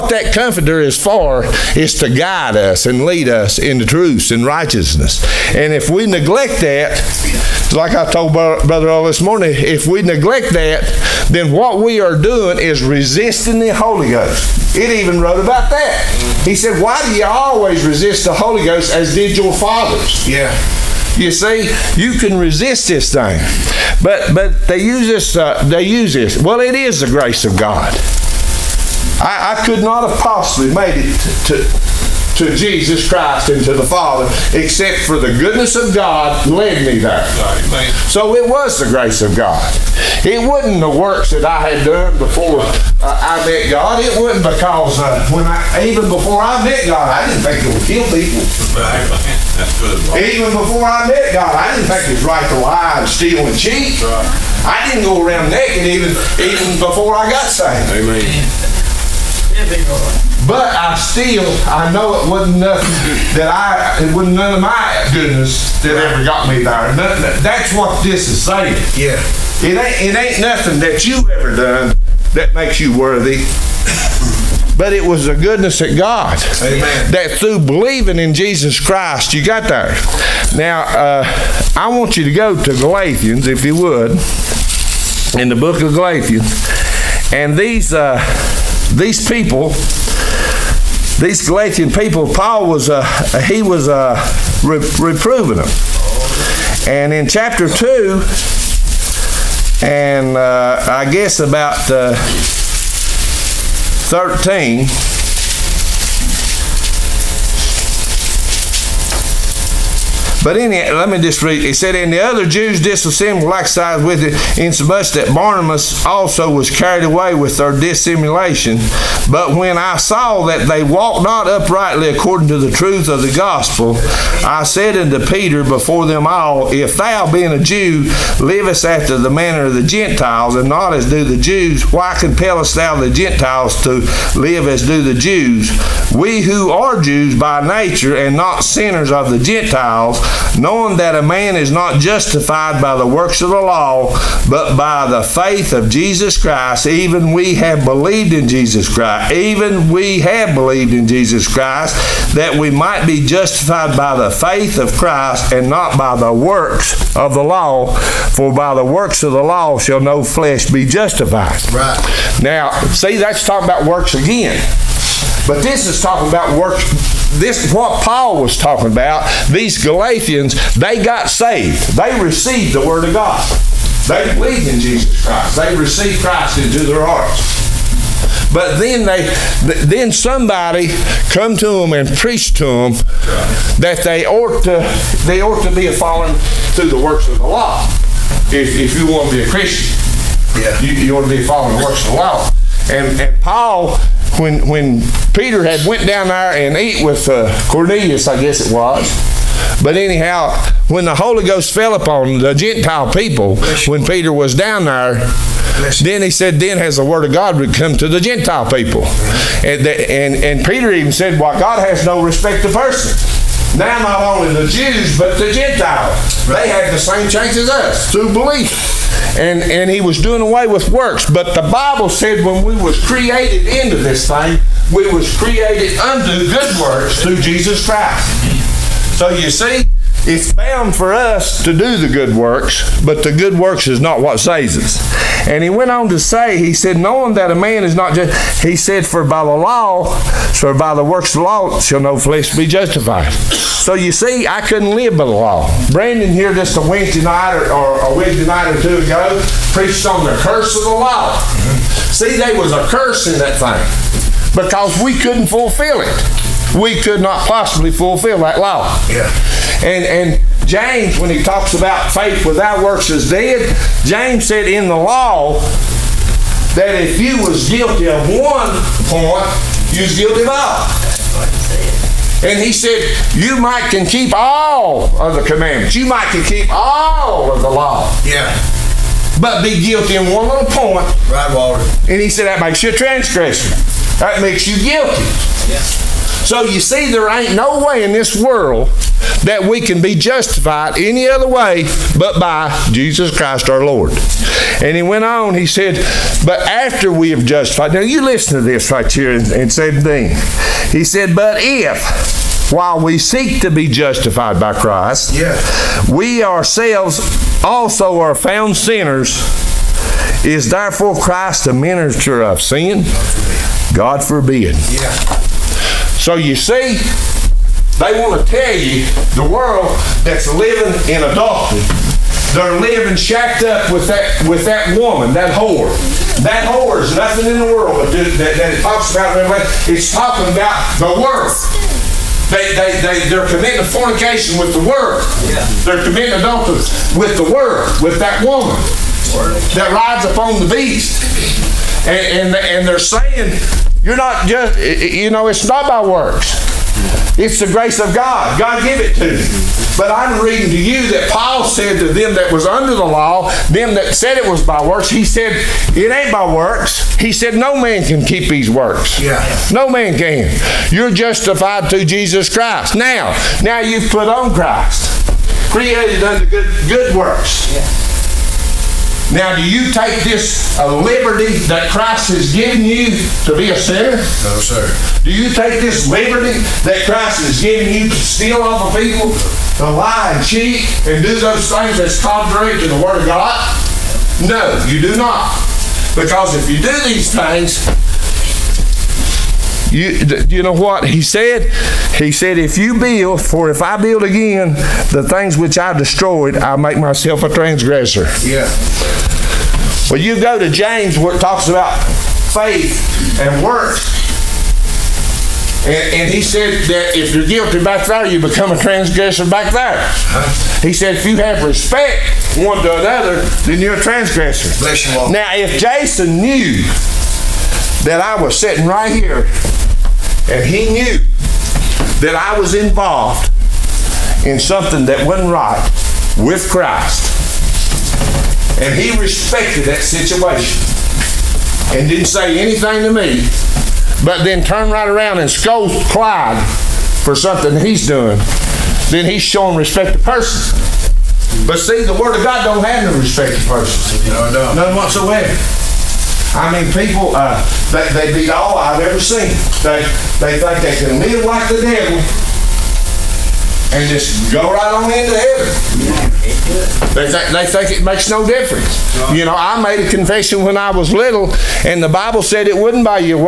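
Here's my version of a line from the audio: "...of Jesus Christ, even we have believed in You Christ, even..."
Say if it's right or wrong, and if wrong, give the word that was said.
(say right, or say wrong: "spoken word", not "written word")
wrong: "Jesus", not "You".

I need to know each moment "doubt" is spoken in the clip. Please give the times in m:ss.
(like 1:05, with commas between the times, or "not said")
not said.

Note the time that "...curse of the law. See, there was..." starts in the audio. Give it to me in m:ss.
4:10.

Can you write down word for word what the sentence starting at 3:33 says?
Now not only the Jews, but the Gentiles.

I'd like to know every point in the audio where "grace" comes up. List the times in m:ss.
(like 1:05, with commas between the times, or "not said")
0:27, 0:38, 5:47.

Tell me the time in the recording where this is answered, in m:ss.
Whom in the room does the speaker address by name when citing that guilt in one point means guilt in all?
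4:41.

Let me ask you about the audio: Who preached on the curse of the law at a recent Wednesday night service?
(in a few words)
Brandon.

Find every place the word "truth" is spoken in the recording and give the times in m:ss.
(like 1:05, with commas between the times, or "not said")
0:03, 2:02.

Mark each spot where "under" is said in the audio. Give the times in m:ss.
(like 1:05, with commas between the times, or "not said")
5:52, 6:06.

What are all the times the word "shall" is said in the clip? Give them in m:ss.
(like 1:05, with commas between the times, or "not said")
2:39, 4:01.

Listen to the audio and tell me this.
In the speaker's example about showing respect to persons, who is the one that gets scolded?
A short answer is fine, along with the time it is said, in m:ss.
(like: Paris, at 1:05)
Clyde, at 7:16.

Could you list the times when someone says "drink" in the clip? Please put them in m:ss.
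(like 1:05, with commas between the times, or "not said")
not said.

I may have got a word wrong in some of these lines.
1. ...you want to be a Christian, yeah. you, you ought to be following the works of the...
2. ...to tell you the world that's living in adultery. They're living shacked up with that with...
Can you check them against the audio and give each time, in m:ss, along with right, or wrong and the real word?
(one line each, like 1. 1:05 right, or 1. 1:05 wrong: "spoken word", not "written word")
1. 3:08 right
2. 5:18 right.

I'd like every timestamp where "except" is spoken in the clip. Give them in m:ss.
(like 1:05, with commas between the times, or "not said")
0:34.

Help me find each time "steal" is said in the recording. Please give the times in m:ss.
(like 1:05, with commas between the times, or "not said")
0:53, 6:18.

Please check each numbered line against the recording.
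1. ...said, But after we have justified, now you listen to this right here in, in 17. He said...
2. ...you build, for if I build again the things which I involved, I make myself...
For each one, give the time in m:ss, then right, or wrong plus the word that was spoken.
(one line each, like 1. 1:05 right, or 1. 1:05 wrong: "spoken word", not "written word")
1. 4:55 right
2. 6:32 wrong: "destroyed", not "involved".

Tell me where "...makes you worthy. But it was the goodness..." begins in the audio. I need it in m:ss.
1:12.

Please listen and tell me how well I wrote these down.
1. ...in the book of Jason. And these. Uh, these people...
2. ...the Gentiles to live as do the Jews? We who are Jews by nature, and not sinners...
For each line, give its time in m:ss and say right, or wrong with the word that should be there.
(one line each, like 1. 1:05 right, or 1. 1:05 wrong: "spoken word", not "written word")
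1. 1:25 wrong: "Galatians", not "Jason"
2. 2:12 right.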